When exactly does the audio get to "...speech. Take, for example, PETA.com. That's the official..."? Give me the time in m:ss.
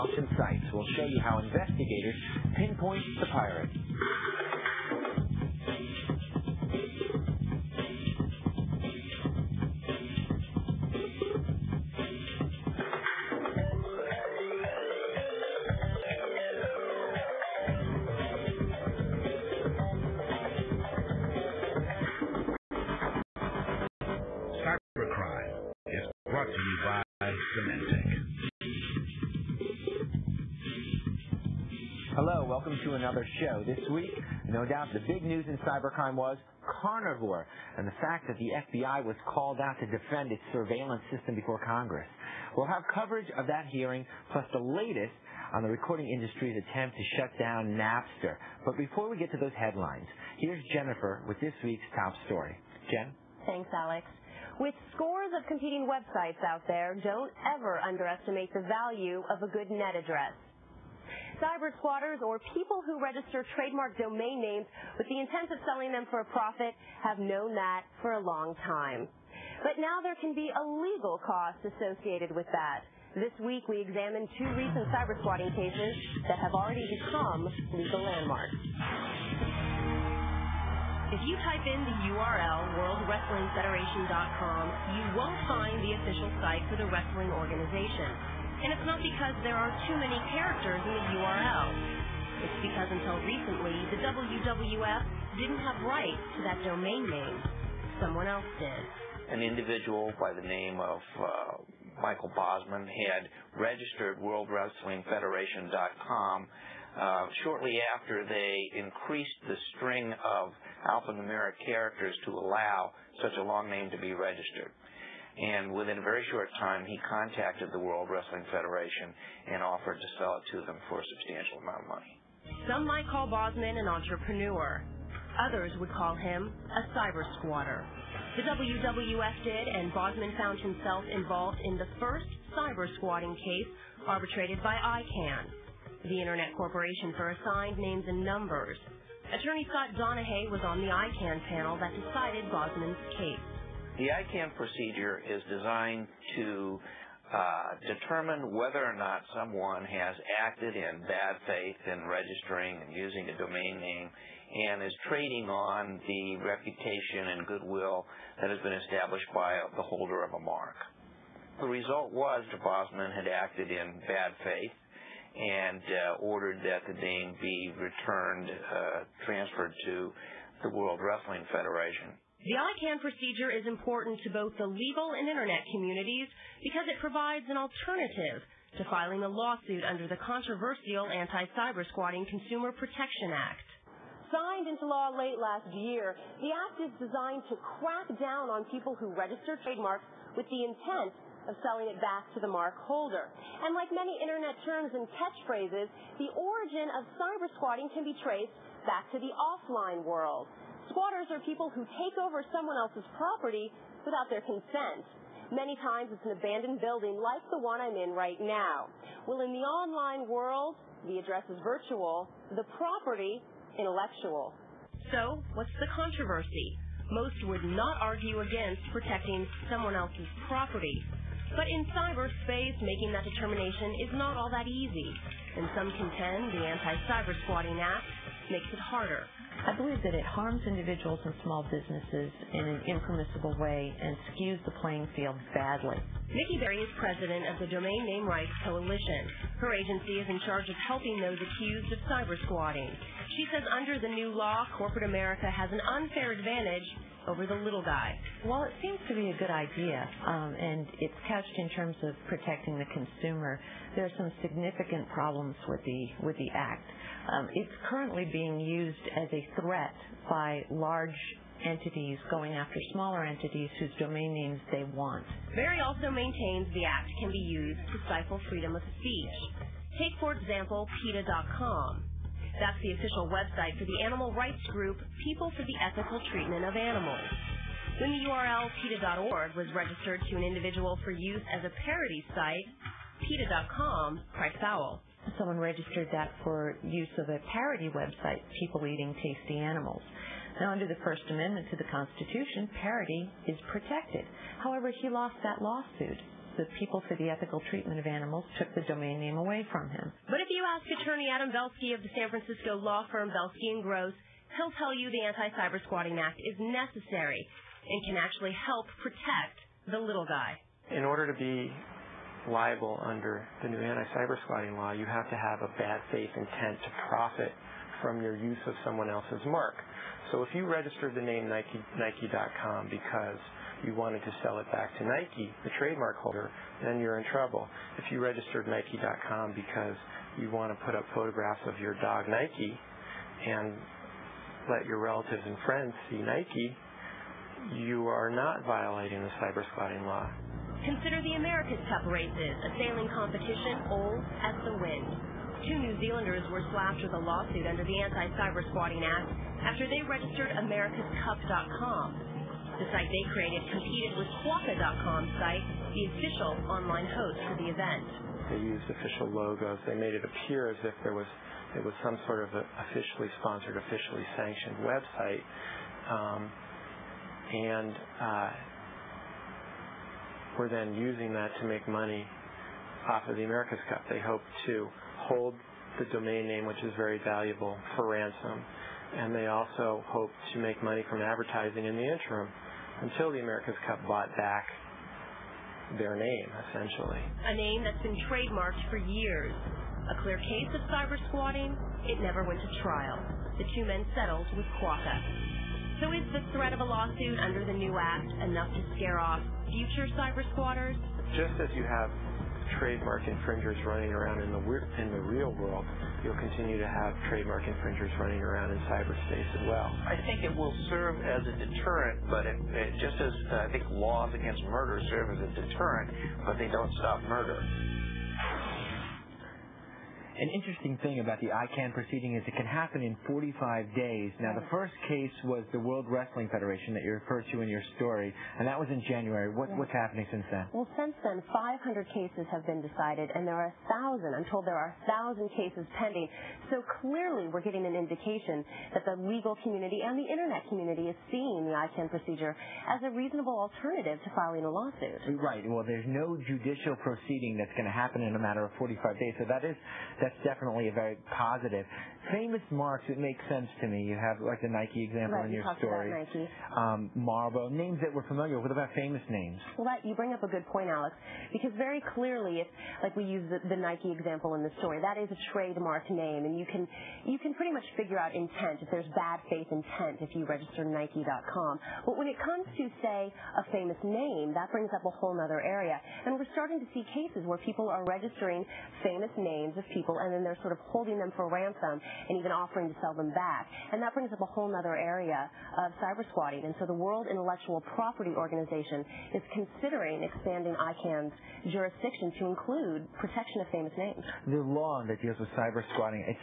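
4:29.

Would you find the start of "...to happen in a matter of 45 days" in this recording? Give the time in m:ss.
7:27.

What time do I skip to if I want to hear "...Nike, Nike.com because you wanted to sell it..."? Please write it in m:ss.
5:21.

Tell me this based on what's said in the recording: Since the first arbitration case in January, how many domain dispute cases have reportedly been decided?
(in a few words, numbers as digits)
500.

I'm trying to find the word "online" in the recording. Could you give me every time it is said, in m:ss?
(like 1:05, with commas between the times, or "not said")
3:29, 5:56.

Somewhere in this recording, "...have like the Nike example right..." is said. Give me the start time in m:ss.
7:34.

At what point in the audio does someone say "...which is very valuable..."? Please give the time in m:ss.
6:16.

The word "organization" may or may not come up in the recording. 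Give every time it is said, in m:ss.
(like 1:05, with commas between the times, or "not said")
1:27, 8:08.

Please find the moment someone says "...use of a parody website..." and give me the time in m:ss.
4:46.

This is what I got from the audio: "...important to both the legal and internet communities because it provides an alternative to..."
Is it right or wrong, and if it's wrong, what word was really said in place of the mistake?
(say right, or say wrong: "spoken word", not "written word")
right.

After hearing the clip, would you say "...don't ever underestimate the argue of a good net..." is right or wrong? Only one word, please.
wrong.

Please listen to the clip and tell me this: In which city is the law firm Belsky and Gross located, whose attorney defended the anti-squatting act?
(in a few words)
San Francisco.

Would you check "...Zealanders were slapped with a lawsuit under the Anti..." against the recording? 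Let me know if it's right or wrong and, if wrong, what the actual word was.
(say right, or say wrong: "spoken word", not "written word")
right.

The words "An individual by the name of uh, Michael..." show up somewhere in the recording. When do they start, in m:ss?
1:39.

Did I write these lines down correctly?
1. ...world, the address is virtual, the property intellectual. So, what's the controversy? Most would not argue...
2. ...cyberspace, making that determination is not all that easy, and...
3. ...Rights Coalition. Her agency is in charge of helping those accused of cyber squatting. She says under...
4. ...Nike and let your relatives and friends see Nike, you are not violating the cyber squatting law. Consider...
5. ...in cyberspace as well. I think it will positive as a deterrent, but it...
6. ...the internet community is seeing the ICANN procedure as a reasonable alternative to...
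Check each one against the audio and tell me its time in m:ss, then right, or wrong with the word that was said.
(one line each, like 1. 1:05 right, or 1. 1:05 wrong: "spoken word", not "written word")
1. 3:30 right
2. 3:41 right
3. 3:58 right
4. 5:32 right
5. 6:48 wrong: "serve", not "positive"
6. 7:20 right.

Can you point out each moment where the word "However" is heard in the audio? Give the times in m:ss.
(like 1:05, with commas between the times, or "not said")
4:54.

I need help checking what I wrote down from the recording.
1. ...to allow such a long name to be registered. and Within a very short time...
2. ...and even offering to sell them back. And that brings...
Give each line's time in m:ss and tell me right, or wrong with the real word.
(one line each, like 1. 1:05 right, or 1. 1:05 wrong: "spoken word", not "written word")
1. 1:52 right
2. 8:02 right.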